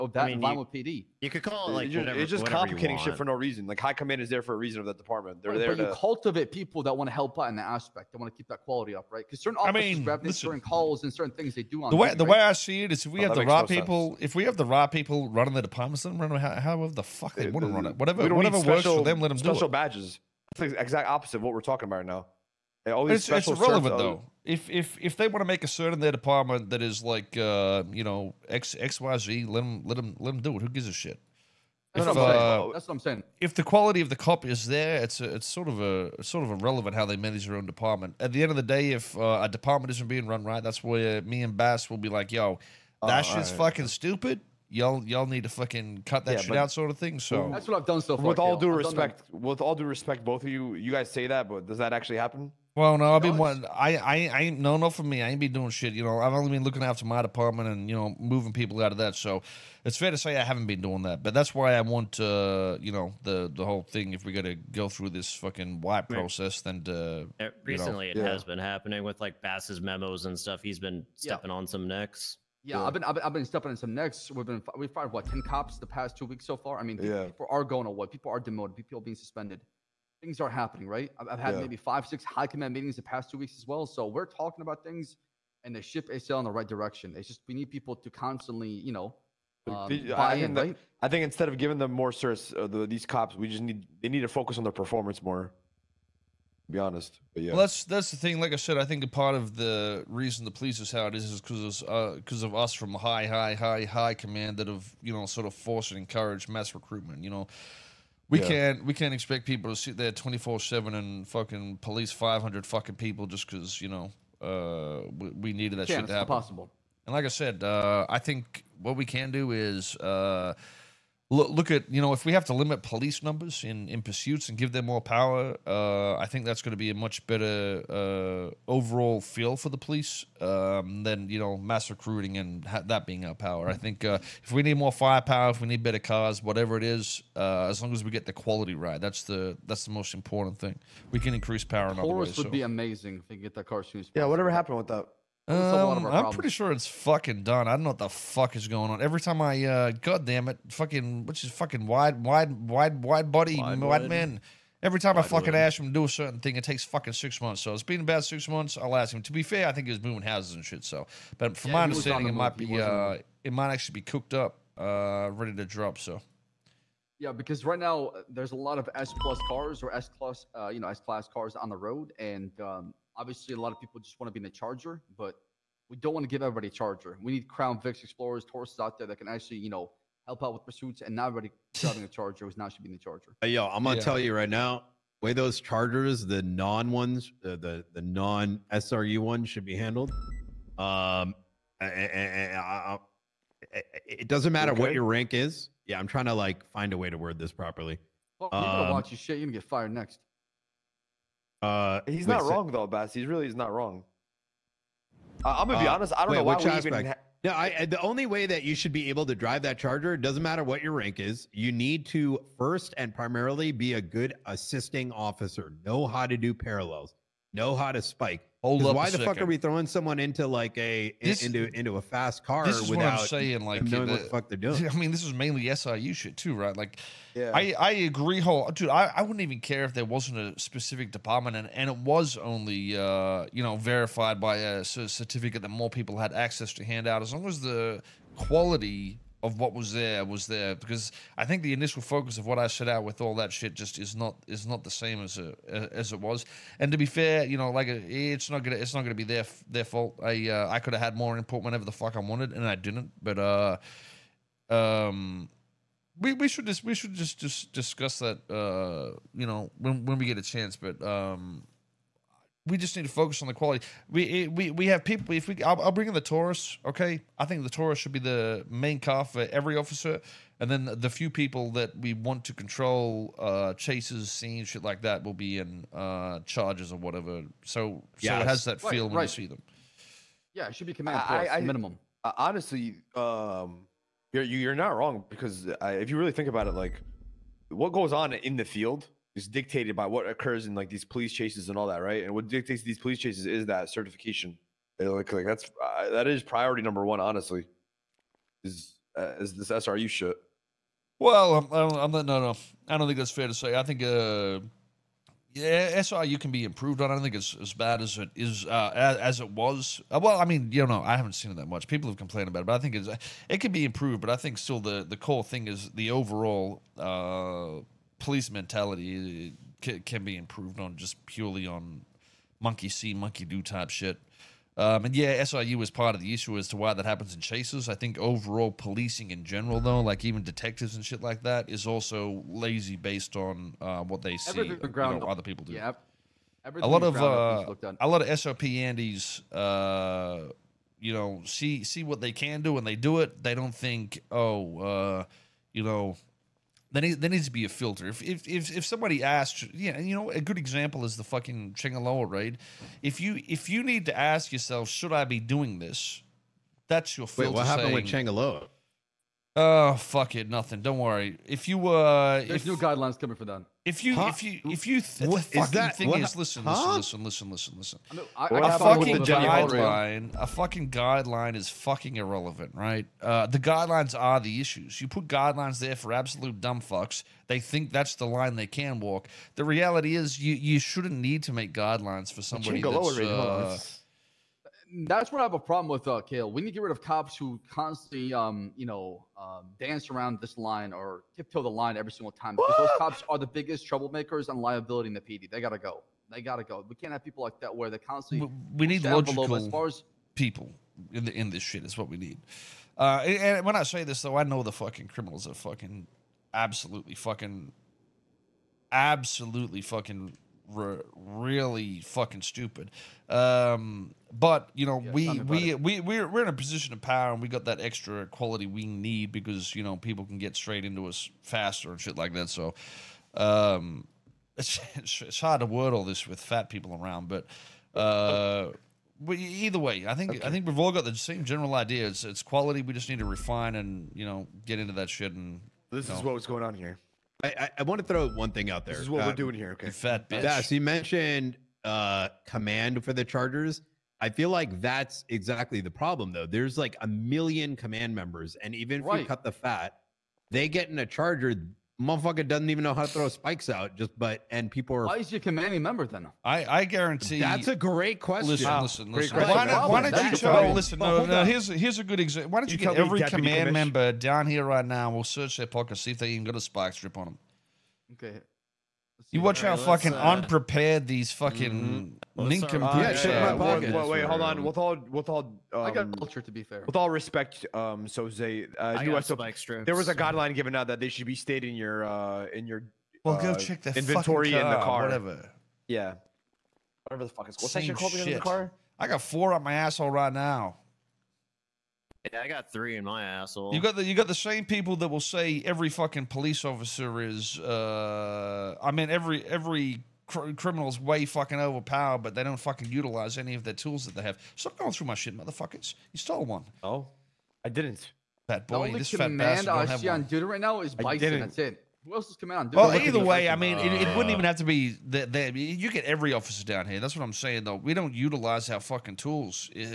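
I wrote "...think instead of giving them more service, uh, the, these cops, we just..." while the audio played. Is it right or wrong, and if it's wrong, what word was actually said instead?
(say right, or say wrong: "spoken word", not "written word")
right.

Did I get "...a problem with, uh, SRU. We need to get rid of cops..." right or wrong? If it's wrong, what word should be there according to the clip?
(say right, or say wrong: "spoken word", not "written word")
wrong: "Kael", not "SRU".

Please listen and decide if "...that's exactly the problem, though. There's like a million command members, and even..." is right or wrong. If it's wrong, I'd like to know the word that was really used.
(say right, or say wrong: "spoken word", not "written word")
right.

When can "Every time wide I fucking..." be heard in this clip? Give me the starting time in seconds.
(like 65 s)
154 s.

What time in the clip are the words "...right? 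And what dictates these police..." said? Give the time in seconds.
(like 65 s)
292 s.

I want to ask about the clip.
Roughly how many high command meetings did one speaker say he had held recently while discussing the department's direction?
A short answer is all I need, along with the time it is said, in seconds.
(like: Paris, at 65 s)
5 or 6, at 81 s.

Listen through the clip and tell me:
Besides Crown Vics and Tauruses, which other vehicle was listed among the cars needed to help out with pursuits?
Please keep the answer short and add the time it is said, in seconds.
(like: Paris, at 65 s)
Explorers, at 178 s.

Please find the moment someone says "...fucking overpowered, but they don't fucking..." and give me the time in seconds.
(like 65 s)
501 s.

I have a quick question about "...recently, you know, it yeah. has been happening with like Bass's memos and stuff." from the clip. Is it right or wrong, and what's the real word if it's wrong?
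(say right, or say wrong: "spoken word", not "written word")
right.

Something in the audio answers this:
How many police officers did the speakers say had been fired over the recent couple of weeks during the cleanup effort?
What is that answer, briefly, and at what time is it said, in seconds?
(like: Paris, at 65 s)
10, at 75 s.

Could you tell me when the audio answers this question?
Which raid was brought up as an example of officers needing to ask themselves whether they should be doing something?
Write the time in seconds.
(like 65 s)
351 s.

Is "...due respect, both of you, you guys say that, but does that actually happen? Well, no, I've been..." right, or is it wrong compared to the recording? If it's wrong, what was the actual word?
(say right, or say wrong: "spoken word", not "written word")
right.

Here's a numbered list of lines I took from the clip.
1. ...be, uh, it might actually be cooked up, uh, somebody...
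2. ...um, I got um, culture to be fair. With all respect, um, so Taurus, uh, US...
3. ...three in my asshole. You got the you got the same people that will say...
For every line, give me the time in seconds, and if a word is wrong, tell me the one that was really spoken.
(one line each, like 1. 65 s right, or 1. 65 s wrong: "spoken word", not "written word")
1. 162 s wrong: "ready", not "somebody"
2. 475 s wrong: "Zay", not "Taurus"
3. 492 s right.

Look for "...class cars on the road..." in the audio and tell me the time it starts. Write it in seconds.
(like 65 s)
171 s.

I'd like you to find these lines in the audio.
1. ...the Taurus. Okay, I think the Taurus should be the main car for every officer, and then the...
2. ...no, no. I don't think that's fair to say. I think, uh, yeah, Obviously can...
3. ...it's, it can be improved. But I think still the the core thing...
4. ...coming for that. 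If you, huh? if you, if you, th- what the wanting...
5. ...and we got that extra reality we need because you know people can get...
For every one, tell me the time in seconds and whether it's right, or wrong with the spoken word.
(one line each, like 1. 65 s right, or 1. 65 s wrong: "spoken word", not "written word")
1. 266 s right
2. 302 s wrong: "SRU", not "Obviously"
3. 312 s right
4. 363 s wrong: "fucking", not "wanting"
5. 417 s wrong: "quality", not "reality".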